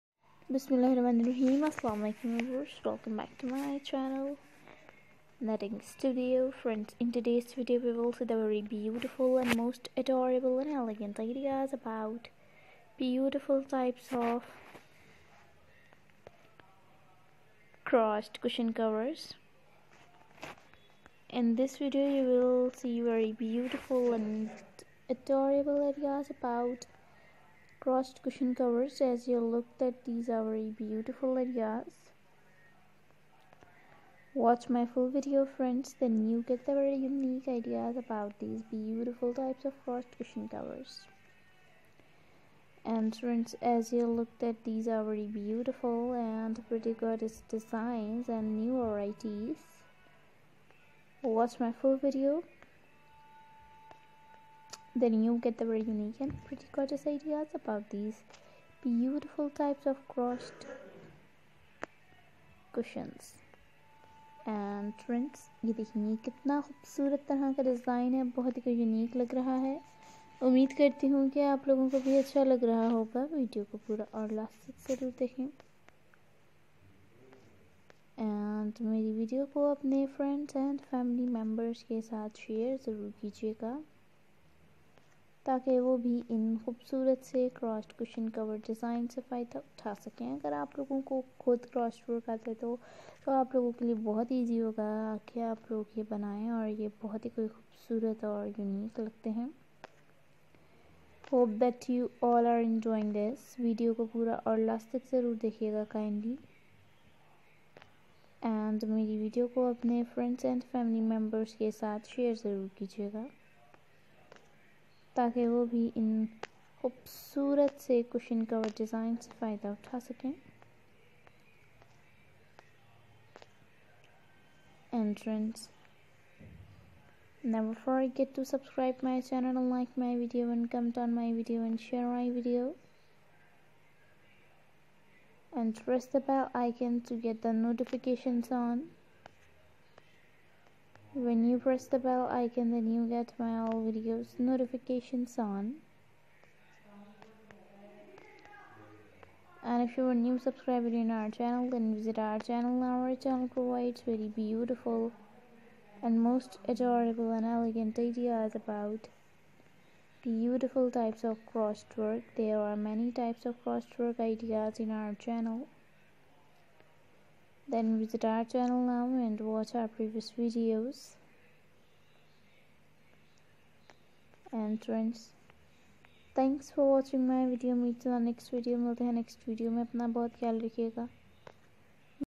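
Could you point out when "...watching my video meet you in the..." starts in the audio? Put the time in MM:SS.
02:56.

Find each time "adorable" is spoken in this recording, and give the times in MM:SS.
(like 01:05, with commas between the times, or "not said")
00:09, 00:25, 02:36.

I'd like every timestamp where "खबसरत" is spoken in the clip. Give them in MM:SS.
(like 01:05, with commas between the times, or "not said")
01:06, 01:26, 01:37, 01:56.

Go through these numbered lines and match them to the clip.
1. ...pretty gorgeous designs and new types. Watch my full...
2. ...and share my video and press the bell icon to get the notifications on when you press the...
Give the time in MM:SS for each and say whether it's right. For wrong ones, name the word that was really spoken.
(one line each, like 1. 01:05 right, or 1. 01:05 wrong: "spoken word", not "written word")
1. 00:46 wrong: "varieties", not "types"
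2. 02:11 right.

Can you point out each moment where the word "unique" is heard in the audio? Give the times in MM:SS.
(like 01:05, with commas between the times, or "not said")
00:36, 00:55.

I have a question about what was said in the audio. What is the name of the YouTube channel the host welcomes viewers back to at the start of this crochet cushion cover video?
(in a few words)
Knitting Studio.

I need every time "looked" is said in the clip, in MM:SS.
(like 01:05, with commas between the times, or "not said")
00:29, 00:44.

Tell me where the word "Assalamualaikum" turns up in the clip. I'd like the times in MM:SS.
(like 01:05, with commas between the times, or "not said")
00:01.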